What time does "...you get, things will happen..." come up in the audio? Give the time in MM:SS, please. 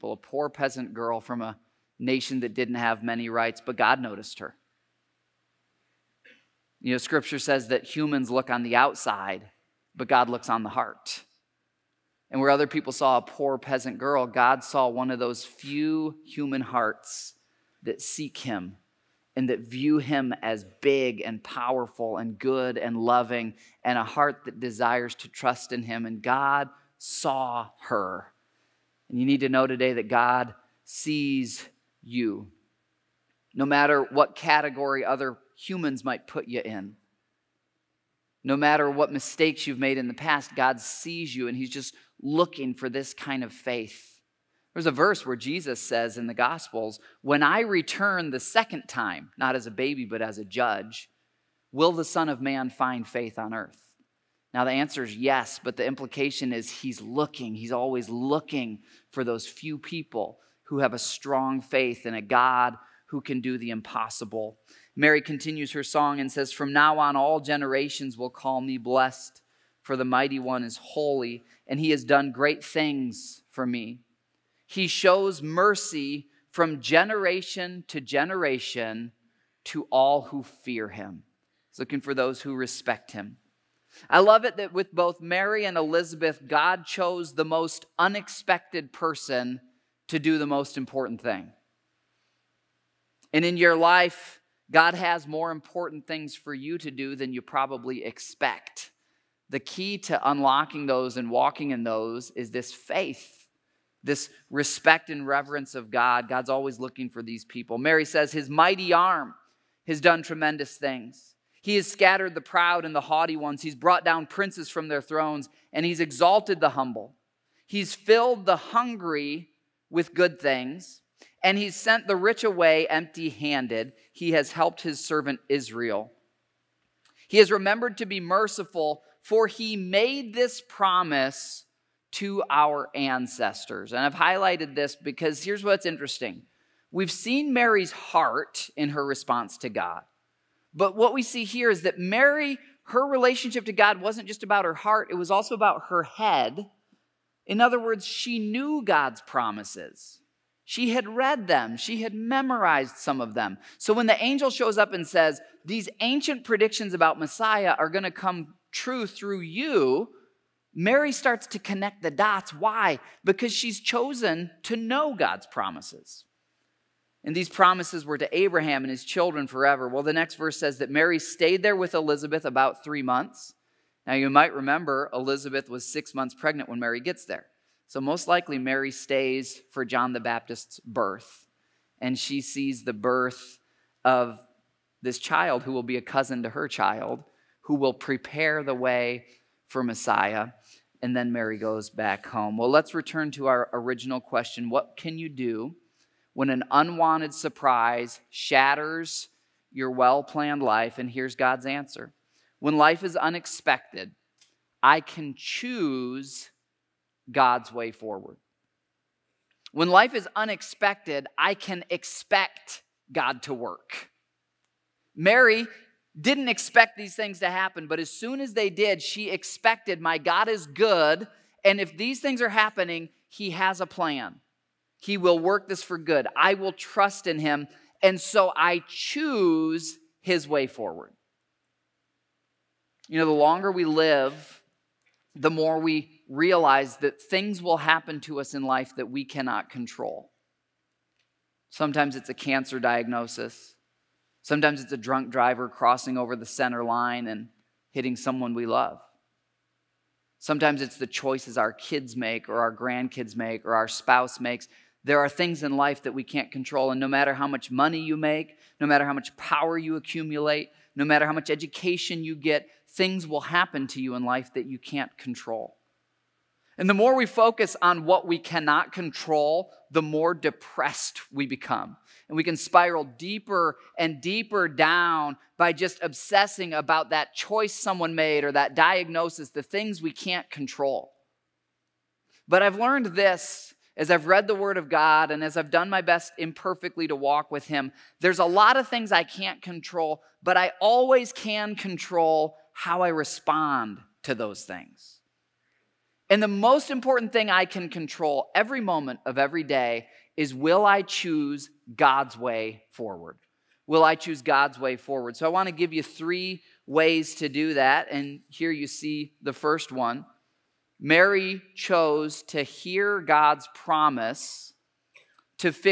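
04:22.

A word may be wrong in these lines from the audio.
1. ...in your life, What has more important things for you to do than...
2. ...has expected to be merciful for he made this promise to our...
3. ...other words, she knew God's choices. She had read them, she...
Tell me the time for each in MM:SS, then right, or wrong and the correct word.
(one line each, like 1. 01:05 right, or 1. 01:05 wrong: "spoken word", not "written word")
1. 01:33 wrong: "God", not "What"
2. 02:07 wrong: "remembered", not "expected"
3. 02:27 wrong: "promises", not "choices".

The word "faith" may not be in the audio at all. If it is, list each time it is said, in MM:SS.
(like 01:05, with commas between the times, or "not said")
00:43, 00:53, 01:01, 01:42.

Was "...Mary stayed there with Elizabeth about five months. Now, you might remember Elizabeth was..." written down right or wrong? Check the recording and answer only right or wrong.
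wrong.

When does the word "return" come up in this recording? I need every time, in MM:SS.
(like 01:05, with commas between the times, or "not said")
00:47, 03:12.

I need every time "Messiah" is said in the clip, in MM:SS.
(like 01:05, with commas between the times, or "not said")
02:37, 03:09.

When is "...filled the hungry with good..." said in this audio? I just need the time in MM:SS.
01:57.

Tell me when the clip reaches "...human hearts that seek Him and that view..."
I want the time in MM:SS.
00:16.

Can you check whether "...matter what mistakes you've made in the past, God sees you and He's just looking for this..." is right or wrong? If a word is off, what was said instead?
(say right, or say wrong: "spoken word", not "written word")
right.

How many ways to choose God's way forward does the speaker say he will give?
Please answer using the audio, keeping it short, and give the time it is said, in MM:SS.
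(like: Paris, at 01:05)
3, at 05:06.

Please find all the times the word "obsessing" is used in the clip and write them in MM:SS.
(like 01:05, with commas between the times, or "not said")
04:36.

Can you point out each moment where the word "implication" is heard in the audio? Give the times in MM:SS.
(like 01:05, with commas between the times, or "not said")
00:55.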